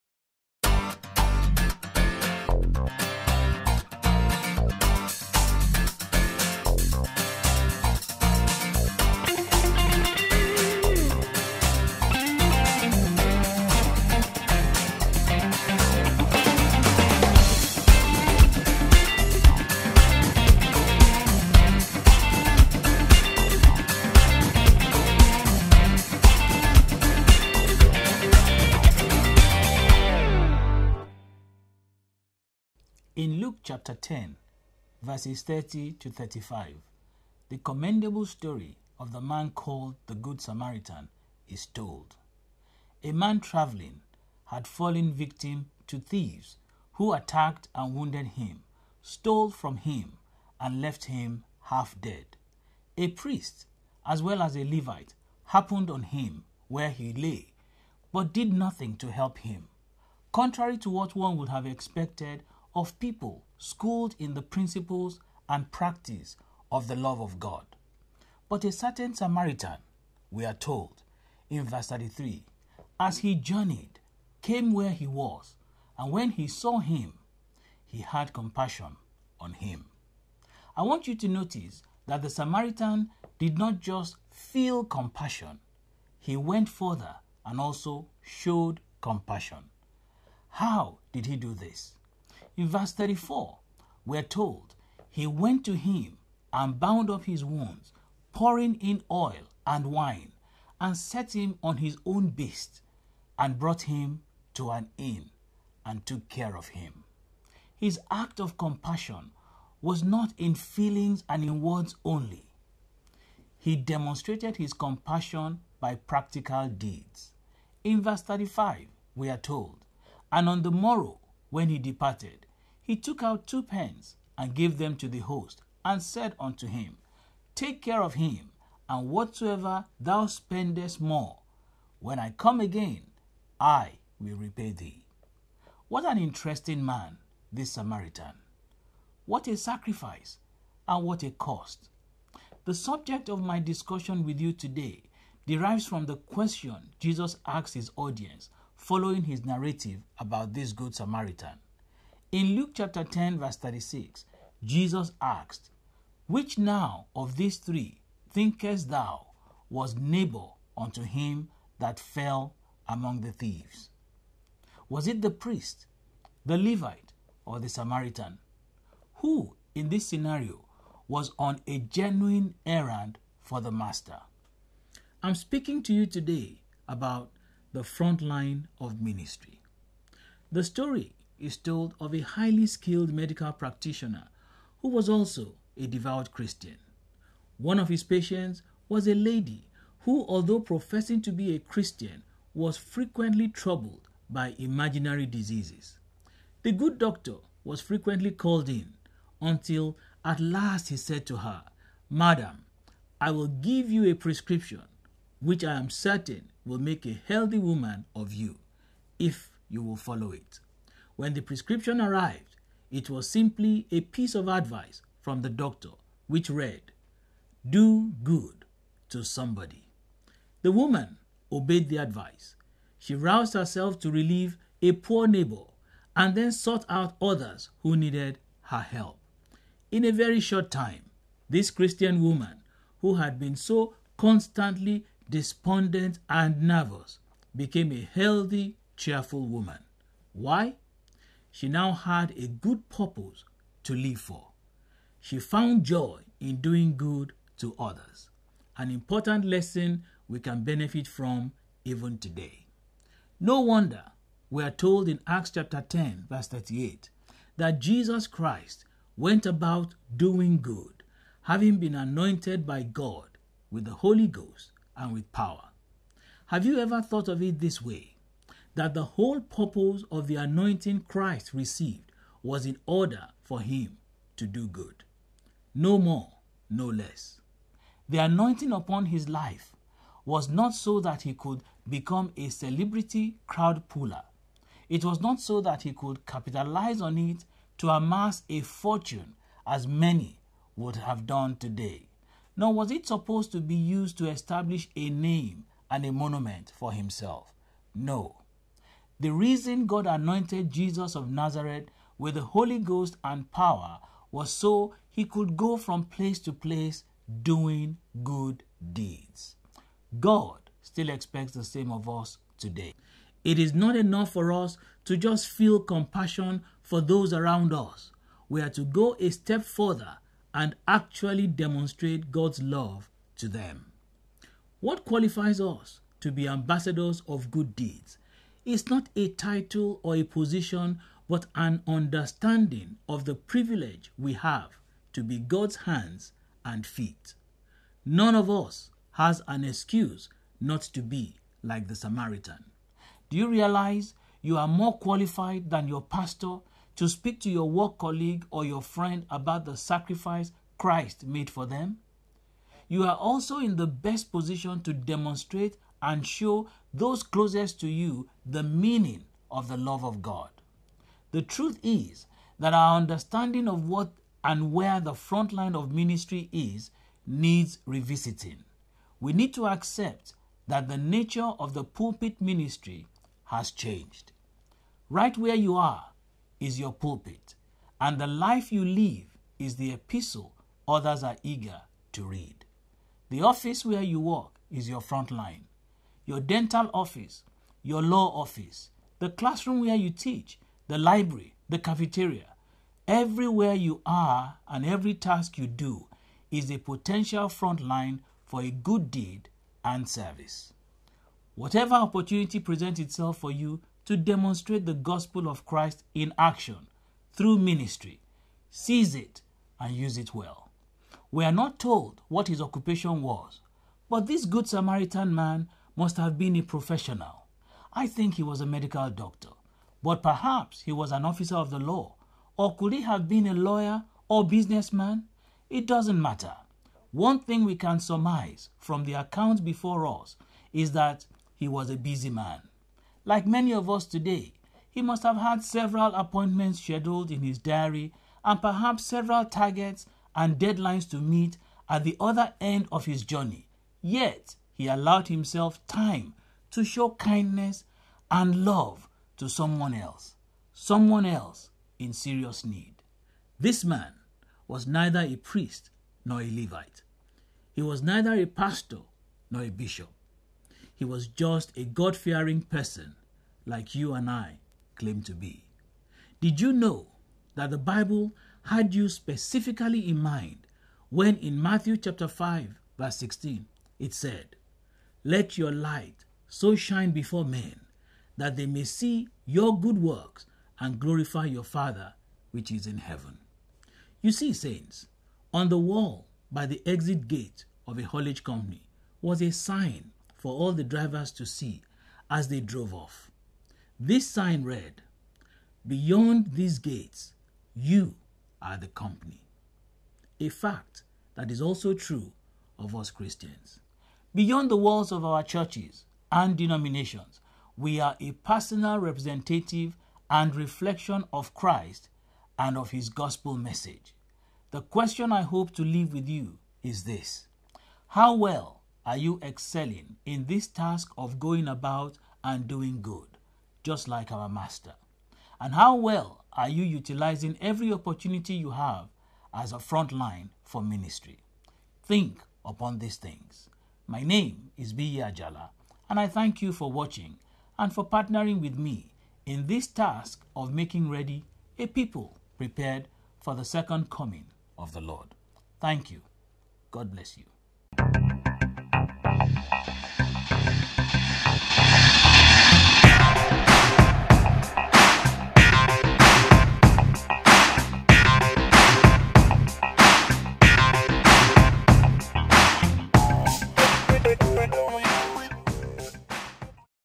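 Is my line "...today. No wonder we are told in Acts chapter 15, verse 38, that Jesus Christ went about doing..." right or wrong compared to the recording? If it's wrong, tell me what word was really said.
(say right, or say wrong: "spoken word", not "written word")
wrong: "10", not "15".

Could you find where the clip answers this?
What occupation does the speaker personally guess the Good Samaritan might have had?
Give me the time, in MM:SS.
06:58.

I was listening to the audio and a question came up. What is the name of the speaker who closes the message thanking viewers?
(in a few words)
Biyi Ajala.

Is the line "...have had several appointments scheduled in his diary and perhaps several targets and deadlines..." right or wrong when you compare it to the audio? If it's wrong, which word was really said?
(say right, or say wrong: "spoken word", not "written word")
right.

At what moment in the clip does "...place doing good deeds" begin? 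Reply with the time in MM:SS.
05:06.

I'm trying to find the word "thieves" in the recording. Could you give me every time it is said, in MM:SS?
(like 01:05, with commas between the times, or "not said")
00:45, 02:43.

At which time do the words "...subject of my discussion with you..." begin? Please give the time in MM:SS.
02:22.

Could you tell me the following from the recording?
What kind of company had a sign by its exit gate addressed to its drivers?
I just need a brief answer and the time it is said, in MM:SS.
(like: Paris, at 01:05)
A haulage company, at 08:08.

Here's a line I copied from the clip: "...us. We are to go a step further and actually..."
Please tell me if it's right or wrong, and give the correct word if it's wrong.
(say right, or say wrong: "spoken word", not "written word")
right.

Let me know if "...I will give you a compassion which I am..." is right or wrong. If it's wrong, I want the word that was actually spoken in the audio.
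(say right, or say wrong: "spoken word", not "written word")
wrong: "prescription", not "compassion".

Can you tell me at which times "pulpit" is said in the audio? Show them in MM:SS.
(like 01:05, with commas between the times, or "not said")
06:11, 06:16.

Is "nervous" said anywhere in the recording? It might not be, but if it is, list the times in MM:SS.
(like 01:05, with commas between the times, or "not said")
03:56.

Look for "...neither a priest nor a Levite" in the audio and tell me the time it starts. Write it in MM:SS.
07:34.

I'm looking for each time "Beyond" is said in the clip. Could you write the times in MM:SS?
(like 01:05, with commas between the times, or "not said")
08:15, 08:24.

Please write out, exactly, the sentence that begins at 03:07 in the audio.
One of his patients was a lady who, although professing to be a Christian, was frequently troubled by imaginary diseases.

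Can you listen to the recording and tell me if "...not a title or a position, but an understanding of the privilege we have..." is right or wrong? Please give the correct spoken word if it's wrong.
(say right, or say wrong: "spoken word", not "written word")
right.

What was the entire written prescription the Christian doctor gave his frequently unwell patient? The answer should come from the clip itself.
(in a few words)
Do good to somebody.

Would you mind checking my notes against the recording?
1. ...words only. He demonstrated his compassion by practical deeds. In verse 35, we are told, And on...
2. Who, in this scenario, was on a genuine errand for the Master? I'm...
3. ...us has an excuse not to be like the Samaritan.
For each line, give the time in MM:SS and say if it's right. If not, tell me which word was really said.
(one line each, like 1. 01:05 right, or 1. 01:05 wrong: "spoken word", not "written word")
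1. 01:51 right
2. 02:49 right
3. 05:38 right.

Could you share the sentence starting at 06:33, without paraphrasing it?
Everywhere you are and every task you do is a potential front line for a good deed and service.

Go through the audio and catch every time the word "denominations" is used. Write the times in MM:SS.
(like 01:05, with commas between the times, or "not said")
08:26.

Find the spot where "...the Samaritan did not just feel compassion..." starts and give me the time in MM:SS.
01:22.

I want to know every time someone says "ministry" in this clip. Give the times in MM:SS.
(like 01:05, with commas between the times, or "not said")
02:59, 06:05, 06:12, 06:47, 08:50.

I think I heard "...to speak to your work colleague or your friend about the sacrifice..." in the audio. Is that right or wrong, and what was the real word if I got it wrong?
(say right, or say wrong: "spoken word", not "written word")
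right.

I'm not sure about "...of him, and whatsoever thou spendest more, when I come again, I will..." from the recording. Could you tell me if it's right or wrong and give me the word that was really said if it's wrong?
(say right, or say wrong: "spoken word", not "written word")
right.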